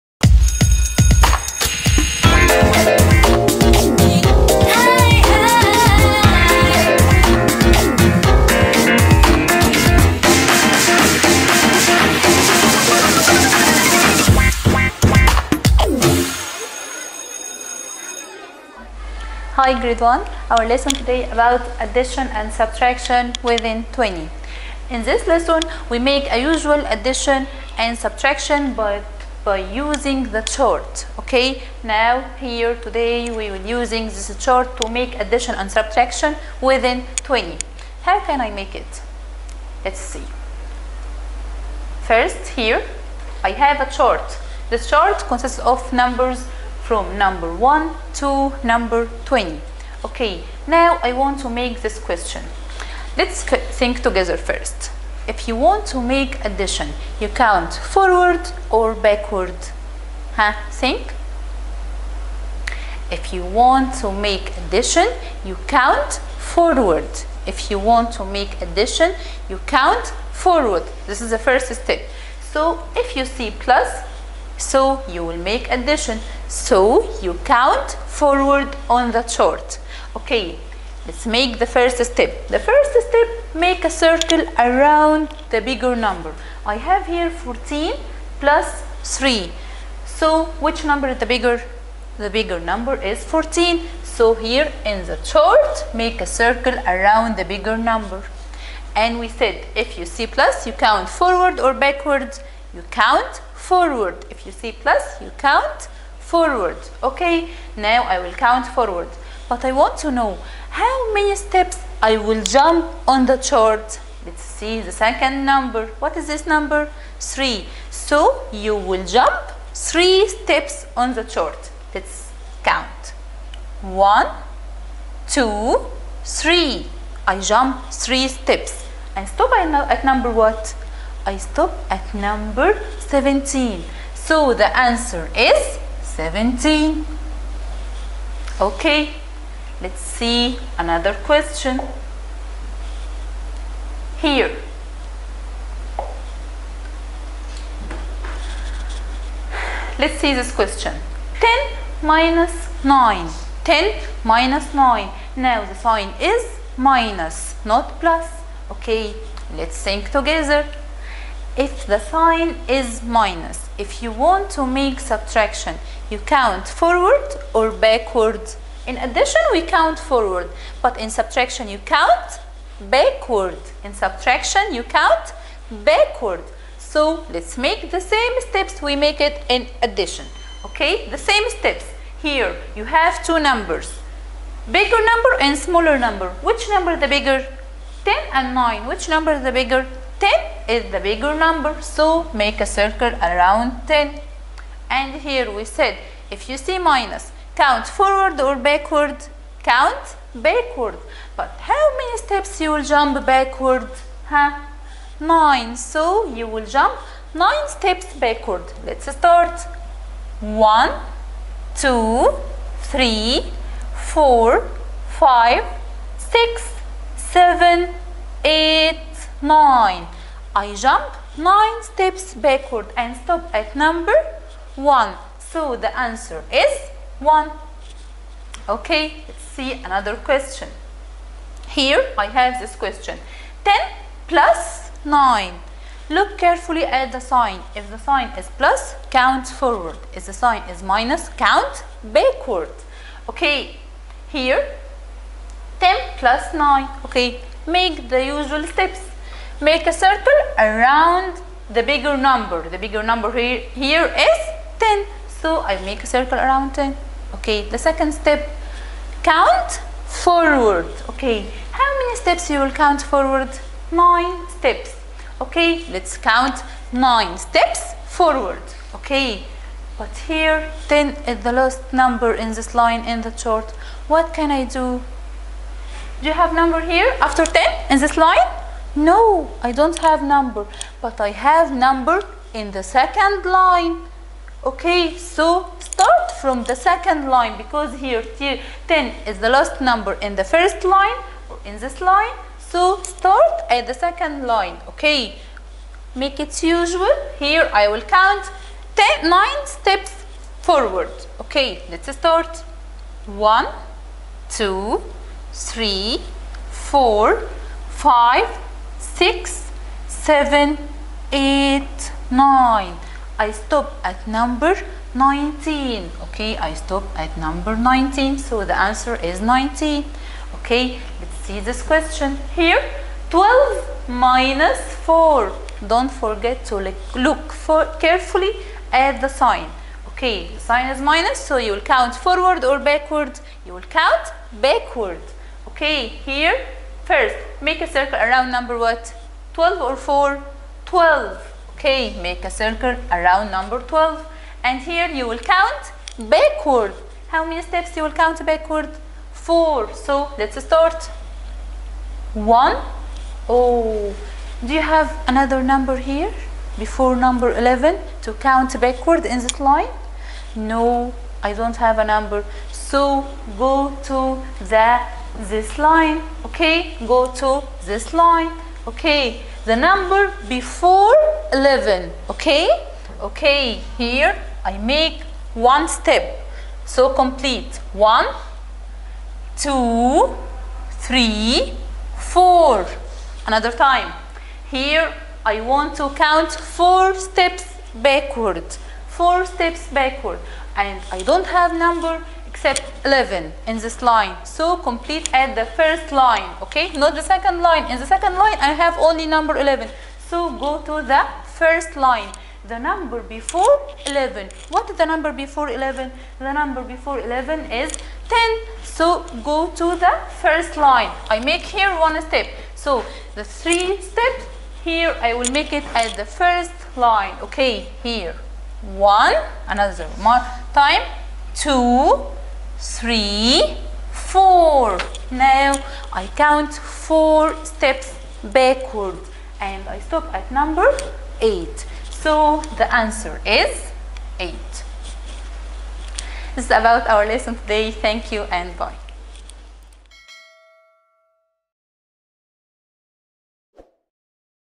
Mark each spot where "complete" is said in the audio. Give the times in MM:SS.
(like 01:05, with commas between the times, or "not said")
06:17, 06:34.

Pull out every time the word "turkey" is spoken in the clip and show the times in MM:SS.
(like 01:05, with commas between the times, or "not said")
not said.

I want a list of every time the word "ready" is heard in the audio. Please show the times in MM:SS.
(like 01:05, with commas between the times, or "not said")
not said.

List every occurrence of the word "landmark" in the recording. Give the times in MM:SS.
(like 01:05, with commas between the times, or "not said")
not said.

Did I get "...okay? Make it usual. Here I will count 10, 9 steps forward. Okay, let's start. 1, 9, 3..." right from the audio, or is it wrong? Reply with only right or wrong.
wrong.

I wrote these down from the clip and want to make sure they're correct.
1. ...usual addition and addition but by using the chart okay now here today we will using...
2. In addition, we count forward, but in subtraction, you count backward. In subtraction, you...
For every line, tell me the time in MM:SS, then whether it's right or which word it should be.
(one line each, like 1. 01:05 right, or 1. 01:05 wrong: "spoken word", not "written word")
1. 00:26 wrong: "subtraction", not "addition"
2. 02:48 right.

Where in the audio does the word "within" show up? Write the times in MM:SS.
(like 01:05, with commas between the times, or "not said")
00:23, 00:36.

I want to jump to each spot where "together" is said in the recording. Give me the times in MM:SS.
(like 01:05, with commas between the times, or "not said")
00:54, 02:40.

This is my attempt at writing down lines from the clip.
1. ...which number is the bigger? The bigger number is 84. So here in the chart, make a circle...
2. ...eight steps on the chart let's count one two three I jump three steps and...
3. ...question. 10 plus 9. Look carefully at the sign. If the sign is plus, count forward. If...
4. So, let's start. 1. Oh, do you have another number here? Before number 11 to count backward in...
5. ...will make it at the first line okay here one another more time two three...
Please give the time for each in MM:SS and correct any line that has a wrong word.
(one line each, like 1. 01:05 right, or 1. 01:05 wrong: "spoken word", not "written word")
1. 01:30 wrong: "14", not "84"
2. 01:59 wrong: "three", not "eight"
3. 03:52 right
4. 05:49 right
5. 06:55 right.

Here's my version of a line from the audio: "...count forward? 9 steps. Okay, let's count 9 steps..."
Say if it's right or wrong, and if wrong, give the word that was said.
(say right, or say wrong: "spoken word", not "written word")
right.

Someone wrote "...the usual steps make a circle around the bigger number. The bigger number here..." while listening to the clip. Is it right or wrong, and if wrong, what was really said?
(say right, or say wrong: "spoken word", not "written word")
right.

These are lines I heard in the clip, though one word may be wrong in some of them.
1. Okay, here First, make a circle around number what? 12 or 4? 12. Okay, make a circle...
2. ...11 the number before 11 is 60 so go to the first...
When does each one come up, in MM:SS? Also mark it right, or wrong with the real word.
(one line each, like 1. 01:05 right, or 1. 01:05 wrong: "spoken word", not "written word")
1. 05:35 right
2. 06:45 wrong: "10", not "60".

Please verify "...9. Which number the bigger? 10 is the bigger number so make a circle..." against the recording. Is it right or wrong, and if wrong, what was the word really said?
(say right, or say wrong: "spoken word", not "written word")
right.